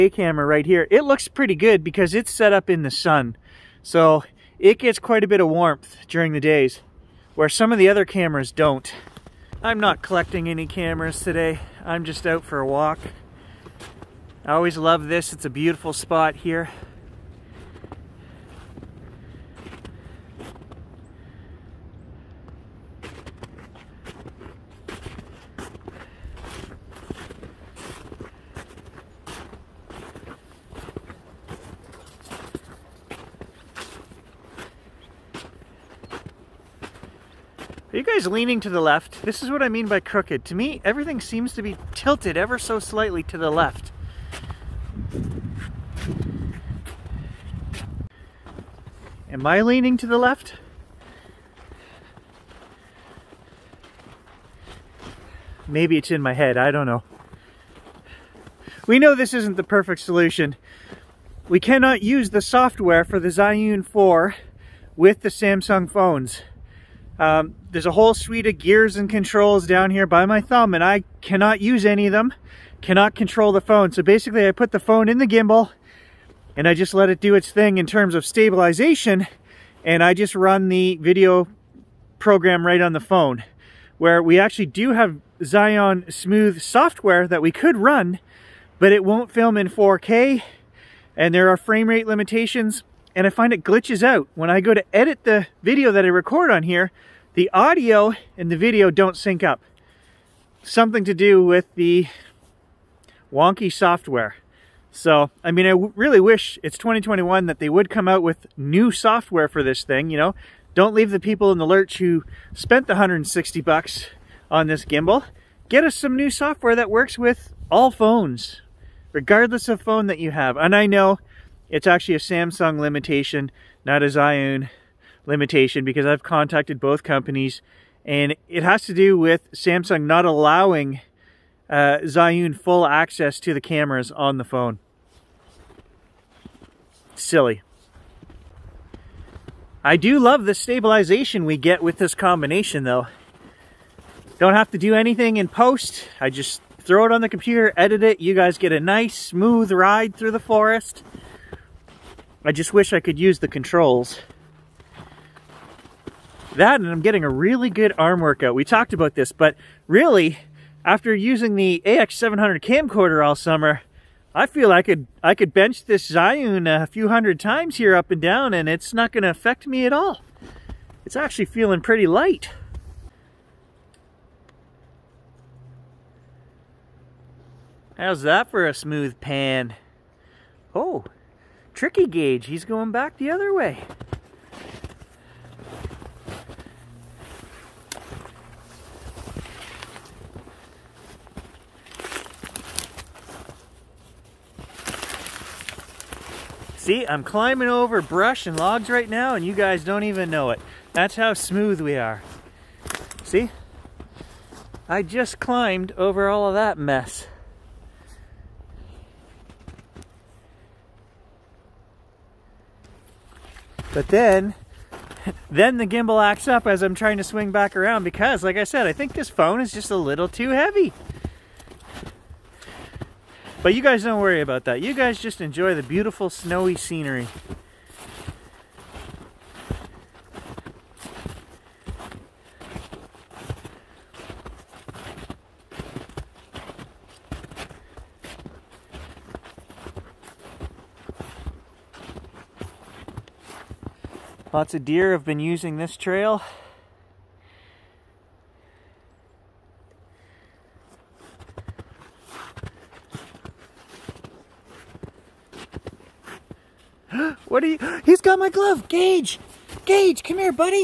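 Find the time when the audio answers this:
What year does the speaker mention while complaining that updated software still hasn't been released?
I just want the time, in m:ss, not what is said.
1:46.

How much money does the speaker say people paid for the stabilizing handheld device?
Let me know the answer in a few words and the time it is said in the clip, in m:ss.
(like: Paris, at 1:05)
$160, at 1:52.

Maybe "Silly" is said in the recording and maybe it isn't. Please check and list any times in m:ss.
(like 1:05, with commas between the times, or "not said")
2:17.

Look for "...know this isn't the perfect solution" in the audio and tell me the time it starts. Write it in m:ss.
0:58.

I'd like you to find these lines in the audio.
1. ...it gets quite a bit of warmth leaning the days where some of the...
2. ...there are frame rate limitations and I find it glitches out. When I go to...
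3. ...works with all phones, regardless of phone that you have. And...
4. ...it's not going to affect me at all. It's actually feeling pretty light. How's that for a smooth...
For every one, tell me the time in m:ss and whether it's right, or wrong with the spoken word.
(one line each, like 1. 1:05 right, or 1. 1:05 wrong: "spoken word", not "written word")
1. 0:04 wrong: "during", not "leaning"
2. 1:31 right
3. 1:56 right
4. 2:48 right.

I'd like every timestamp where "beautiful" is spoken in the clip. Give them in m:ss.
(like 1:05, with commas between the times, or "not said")
0:15, 3:45.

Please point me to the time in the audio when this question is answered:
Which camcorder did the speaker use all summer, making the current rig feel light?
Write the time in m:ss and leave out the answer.
2:41.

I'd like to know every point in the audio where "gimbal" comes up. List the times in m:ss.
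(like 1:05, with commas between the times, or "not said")
1:15, 1:54, 3:35.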